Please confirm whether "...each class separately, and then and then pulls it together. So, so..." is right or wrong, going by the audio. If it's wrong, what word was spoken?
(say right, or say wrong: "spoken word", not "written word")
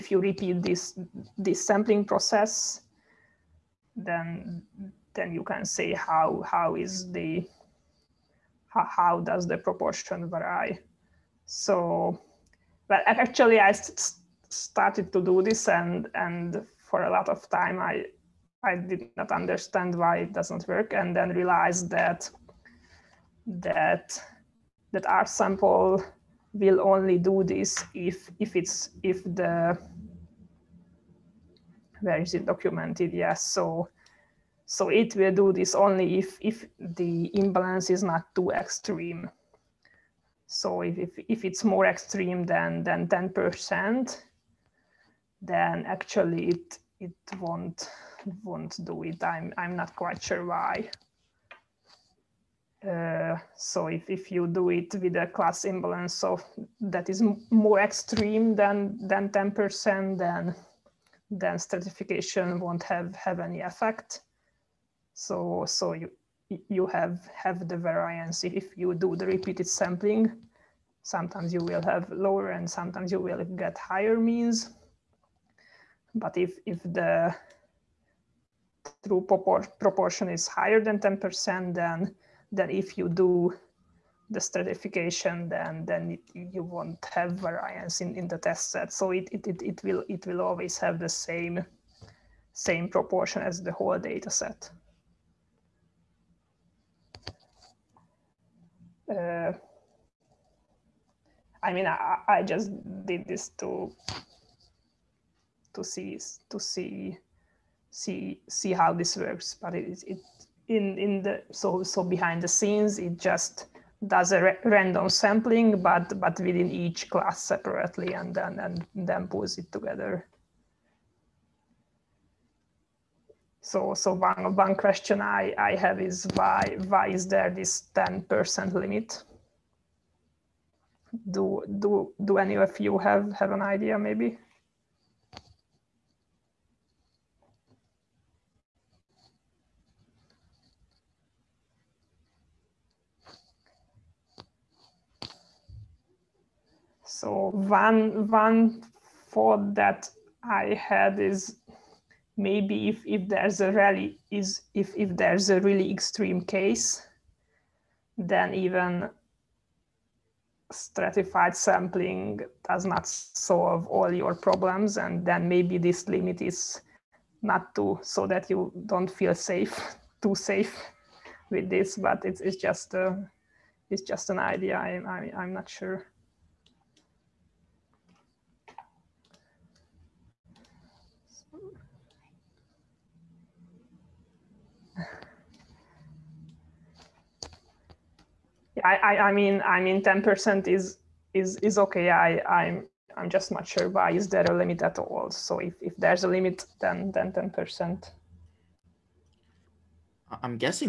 right.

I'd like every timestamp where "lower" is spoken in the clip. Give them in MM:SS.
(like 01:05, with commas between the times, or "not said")
01:12.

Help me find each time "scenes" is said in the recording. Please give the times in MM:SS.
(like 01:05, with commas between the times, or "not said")
01:52.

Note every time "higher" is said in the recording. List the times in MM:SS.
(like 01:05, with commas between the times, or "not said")
01:13, 01:20.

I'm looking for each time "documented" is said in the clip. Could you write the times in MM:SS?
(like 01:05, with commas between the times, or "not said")
00:32.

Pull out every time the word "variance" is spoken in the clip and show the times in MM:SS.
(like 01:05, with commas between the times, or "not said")
01:07, 01:27.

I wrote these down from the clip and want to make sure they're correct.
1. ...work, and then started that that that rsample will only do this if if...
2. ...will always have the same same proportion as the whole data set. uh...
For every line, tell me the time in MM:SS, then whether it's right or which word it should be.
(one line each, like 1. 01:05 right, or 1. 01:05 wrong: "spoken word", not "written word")
1. 00:20 wrong: "realized", not "started"
2. 01:30 right.